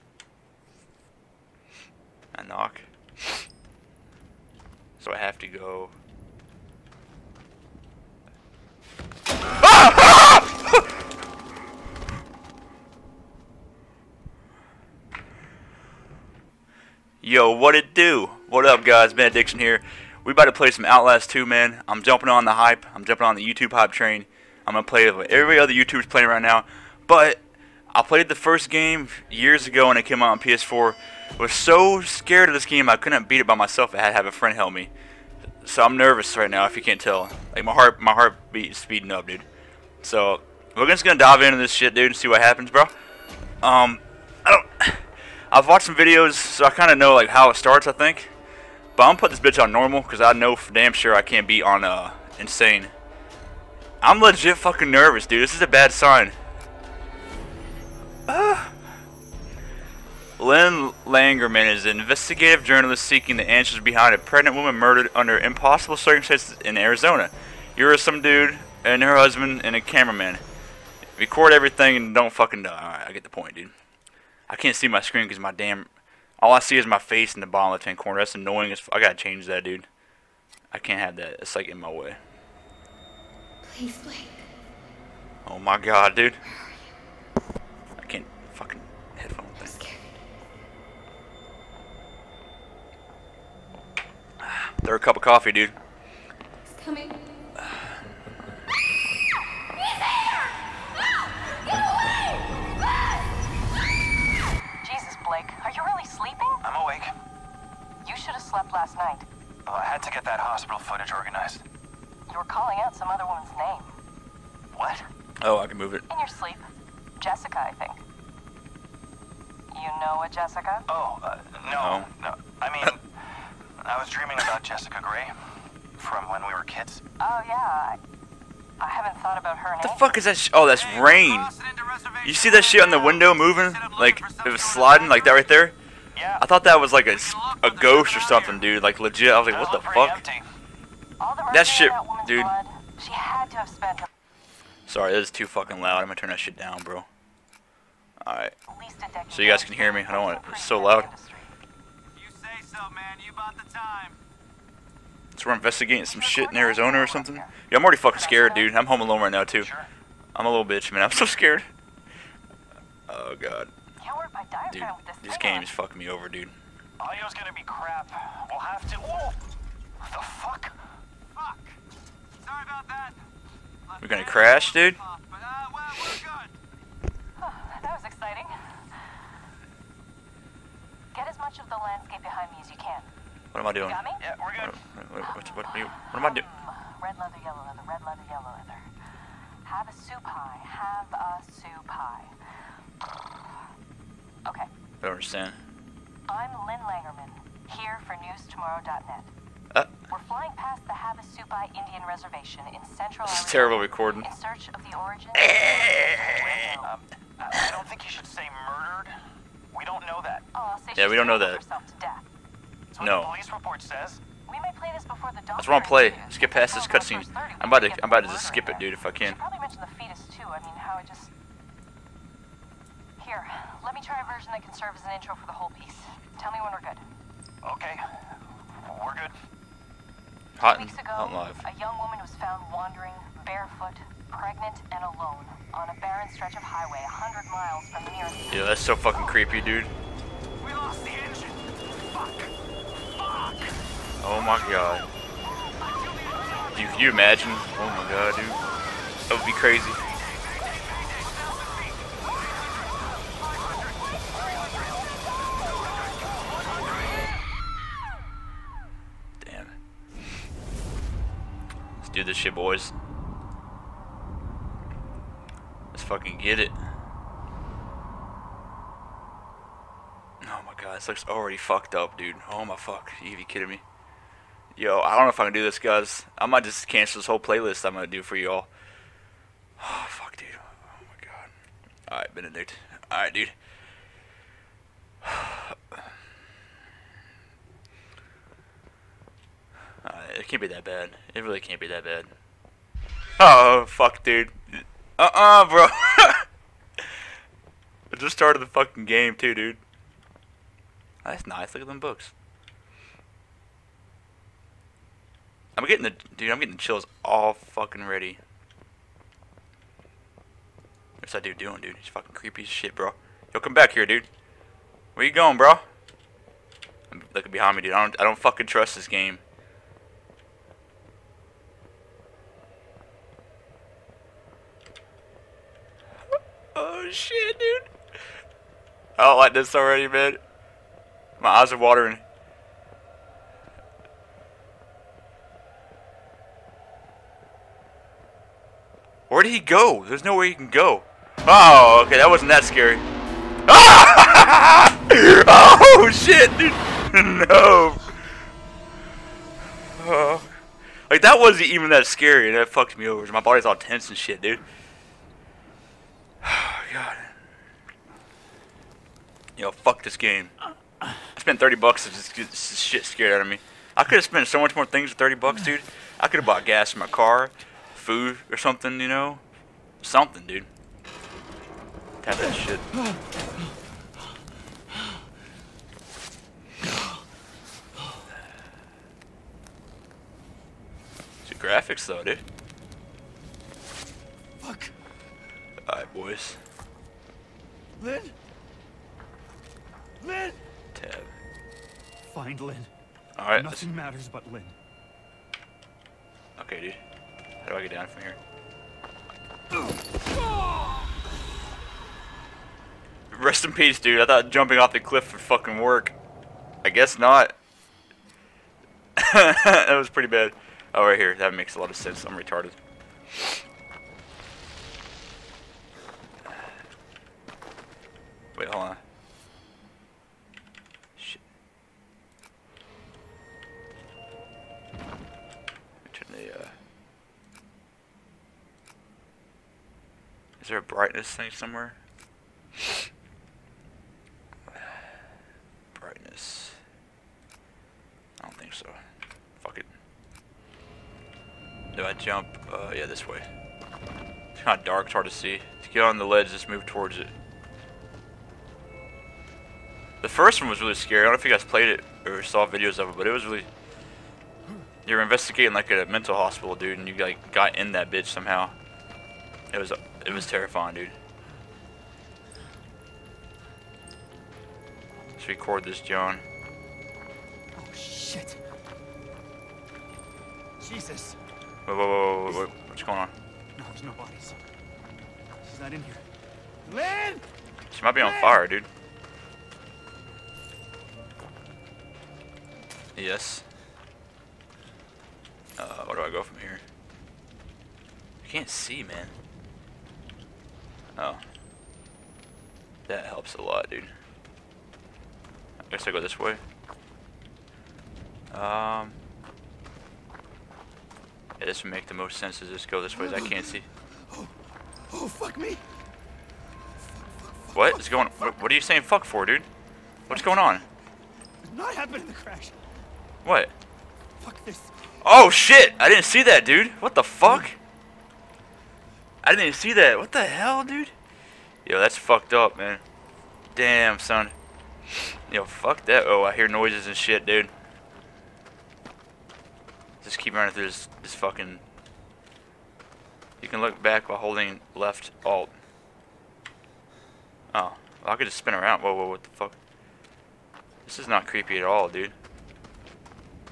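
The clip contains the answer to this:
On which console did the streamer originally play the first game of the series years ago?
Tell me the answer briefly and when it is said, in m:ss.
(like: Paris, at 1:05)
PS4, at 0:30.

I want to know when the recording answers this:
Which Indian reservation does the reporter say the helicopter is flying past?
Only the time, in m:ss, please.
3:20.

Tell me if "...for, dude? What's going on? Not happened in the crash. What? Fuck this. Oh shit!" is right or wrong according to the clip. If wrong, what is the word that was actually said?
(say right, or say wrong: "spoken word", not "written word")
right.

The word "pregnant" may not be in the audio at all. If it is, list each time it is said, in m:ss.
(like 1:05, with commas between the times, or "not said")
1:04, 3:54.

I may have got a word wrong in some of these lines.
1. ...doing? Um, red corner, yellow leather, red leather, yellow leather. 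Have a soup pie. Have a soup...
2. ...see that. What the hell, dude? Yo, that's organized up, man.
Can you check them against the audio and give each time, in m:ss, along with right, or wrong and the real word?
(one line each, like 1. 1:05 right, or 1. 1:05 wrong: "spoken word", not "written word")
1. 3:06 wrong: "leather", not "corner"
2. 8:39 wrong: "fucked", not "organized".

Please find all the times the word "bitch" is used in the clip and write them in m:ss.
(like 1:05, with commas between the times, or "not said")
0:49, 2:40, 7:38.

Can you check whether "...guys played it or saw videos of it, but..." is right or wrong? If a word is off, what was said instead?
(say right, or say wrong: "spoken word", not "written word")
right.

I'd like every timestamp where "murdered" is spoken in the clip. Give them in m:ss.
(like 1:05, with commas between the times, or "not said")
1:04, 3:28.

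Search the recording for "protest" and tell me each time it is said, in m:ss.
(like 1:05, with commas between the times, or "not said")
not said.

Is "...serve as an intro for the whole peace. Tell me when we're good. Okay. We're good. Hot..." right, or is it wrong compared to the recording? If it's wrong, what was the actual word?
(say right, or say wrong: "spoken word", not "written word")
wrong: "piece", not "peace".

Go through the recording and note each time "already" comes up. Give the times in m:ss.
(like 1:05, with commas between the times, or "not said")
2:37, 4:31, 5:29.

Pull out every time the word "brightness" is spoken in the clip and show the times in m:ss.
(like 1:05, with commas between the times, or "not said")
7:10, 7:15.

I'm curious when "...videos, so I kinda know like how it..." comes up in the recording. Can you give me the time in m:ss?
0:45.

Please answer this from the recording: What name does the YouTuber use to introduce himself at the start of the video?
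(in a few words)
Benediction.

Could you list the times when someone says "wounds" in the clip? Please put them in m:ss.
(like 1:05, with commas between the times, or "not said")
not said.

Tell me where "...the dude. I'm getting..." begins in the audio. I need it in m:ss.
5:06.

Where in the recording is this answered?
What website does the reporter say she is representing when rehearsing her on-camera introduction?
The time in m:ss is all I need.
3:18.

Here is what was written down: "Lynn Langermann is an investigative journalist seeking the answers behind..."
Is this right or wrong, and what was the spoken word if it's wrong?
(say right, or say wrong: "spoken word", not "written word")
right.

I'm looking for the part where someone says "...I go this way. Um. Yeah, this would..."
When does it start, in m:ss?
8:16.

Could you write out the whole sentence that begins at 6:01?
I spent 30 bucks to just get this shit scared out of me.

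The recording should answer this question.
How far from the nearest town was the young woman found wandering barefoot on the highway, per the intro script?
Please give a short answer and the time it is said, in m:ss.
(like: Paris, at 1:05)
100 miles, at 3:57.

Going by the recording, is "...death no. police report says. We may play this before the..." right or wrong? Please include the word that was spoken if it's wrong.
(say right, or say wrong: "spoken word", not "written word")
right.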